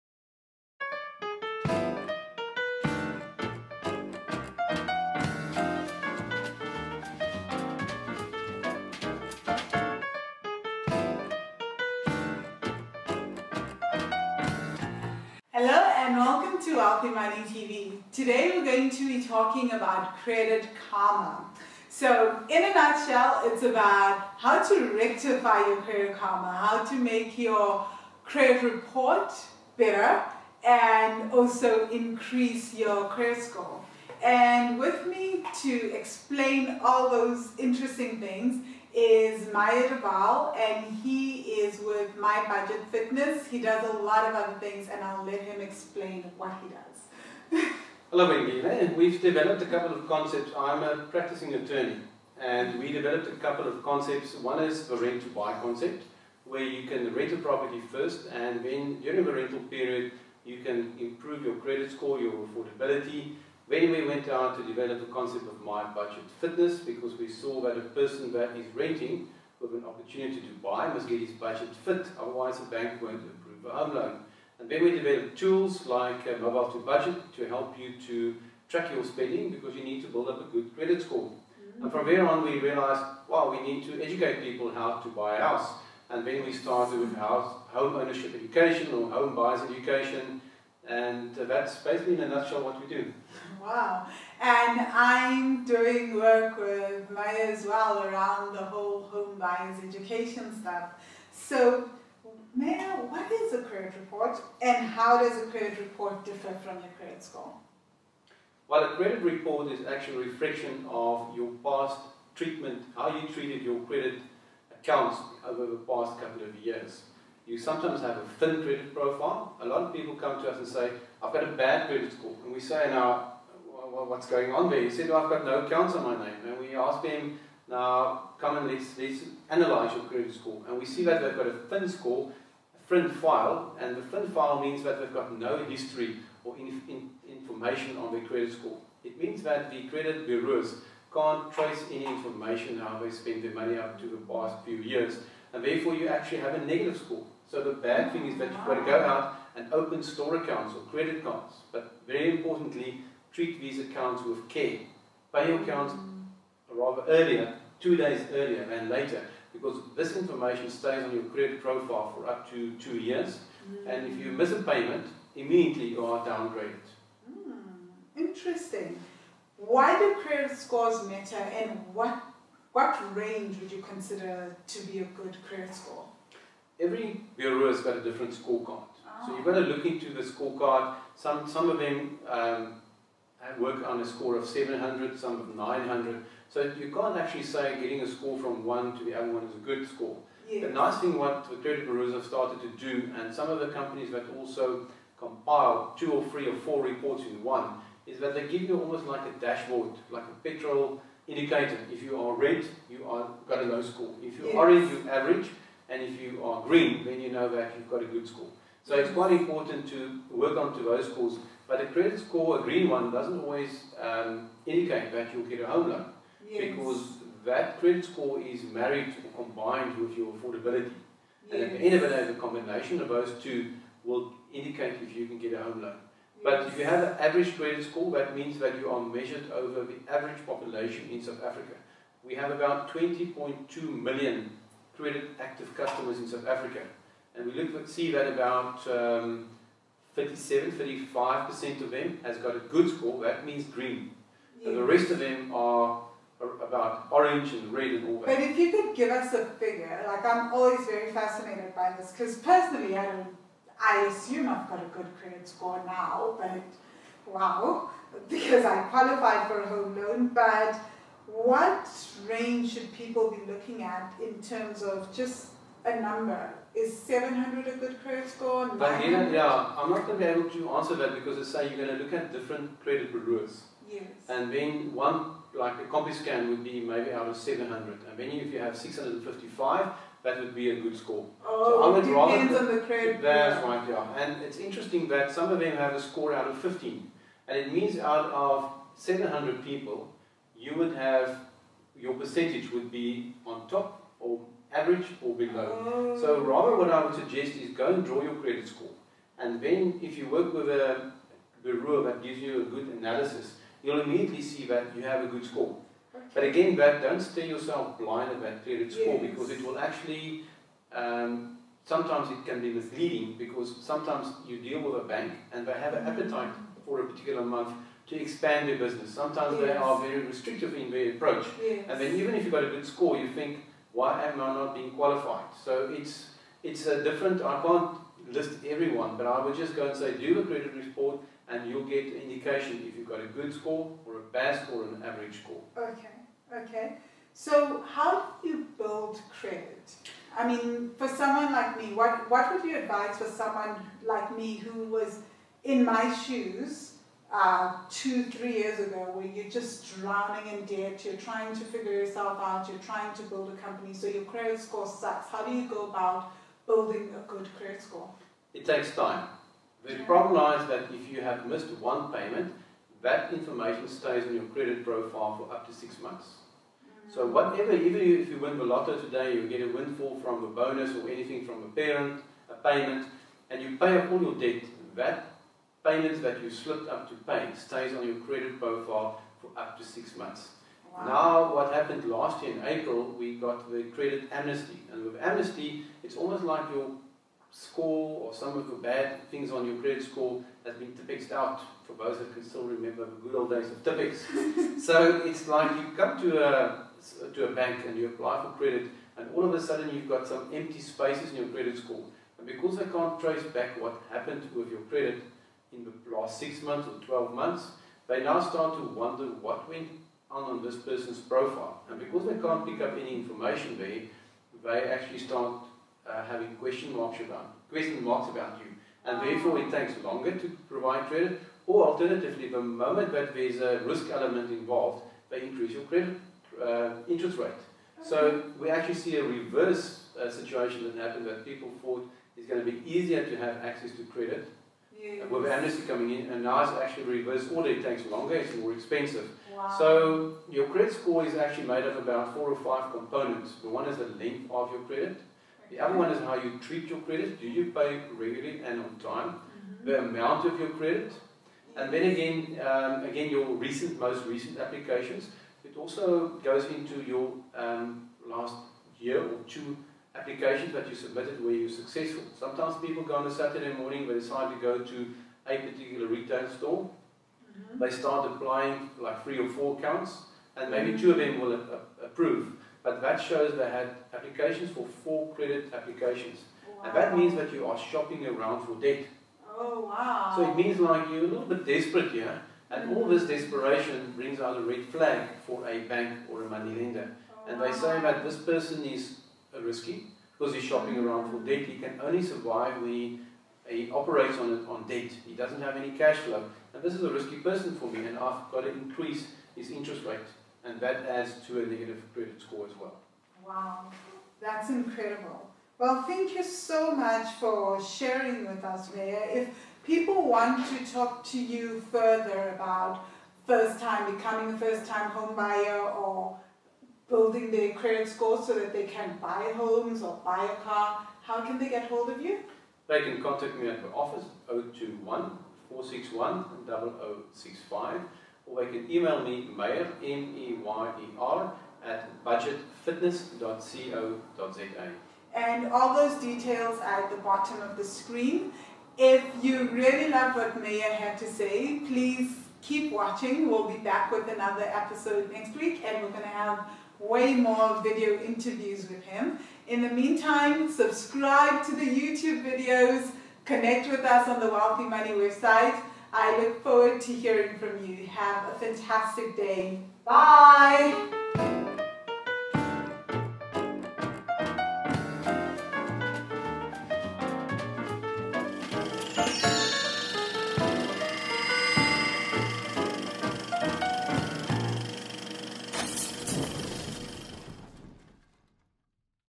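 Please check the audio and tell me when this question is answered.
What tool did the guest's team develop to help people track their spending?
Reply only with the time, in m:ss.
1:16.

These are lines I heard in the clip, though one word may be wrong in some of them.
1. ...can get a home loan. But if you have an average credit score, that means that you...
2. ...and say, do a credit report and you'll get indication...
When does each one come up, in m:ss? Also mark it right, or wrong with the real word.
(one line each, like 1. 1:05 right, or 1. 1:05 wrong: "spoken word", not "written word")
1. 3:45 right
2. 5:29 right.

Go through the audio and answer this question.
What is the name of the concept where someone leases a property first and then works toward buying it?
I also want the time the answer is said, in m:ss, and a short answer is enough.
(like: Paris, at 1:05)
Rent to buy, at 0:54.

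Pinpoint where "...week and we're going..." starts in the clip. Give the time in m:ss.
9:05.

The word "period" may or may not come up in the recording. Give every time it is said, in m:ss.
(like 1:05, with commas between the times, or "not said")
0:59, 5:08.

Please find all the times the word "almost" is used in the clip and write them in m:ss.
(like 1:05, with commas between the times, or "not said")
3:18, 6:26.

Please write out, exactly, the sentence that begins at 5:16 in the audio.
appetite for a particular month to expand their business.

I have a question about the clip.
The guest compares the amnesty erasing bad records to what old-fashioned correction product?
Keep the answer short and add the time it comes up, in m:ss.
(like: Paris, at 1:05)
Tipex, at 6:33.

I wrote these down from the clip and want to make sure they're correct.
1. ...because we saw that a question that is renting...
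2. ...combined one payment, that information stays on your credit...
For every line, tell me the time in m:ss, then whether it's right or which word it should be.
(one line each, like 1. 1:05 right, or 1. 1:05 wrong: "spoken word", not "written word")
1. 1:06 wrong: "person", not "question"
2. 6:01 wrong: "missed", not "combined".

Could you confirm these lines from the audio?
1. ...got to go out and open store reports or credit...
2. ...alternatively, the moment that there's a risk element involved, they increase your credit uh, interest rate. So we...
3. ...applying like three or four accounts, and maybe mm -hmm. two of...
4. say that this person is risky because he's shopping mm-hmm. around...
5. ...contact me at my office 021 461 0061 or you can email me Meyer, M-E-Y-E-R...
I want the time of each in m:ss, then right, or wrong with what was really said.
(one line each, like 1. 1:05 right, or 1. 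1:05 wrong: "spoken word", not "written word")
1. 2:28 wrong: "accounts", not "reports"
2. 7:01 right
3. 7:48 right
4. 8:07 right
5. 8:43 wrong: "0065", not "0061".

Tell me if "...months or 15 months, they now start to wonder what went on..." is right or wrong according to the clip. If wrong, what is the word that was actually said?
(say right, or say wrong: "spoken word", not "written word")
wrong: "12", not "15".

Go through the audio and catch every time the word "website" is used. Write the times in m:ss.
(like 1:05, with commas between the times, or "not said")
9:15.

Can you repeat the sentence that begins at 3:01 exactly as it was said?
Some, some of them um, work on a score of 700, some of 900.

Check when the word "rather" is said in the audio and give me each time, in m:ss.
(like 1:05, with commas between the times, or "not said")
2:36, 4:42, 4:56.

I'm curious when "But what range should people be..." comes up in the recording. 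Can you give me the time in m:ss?
4:20.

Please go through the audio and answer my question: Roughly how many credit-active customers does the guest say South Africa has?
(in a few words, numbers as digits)
20.2 million.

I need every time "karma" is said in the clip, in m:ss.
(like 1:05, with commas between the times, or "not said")
0:20, 0:26.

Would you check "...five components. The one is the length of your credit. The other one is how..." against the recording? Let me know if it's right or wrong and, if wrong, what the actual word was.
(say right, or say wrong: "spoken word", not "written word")
right.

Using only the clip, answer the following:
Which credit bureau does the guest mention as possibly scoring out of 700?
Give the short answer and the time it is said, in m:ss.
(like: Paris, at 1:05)
Compuscan, at 4:35.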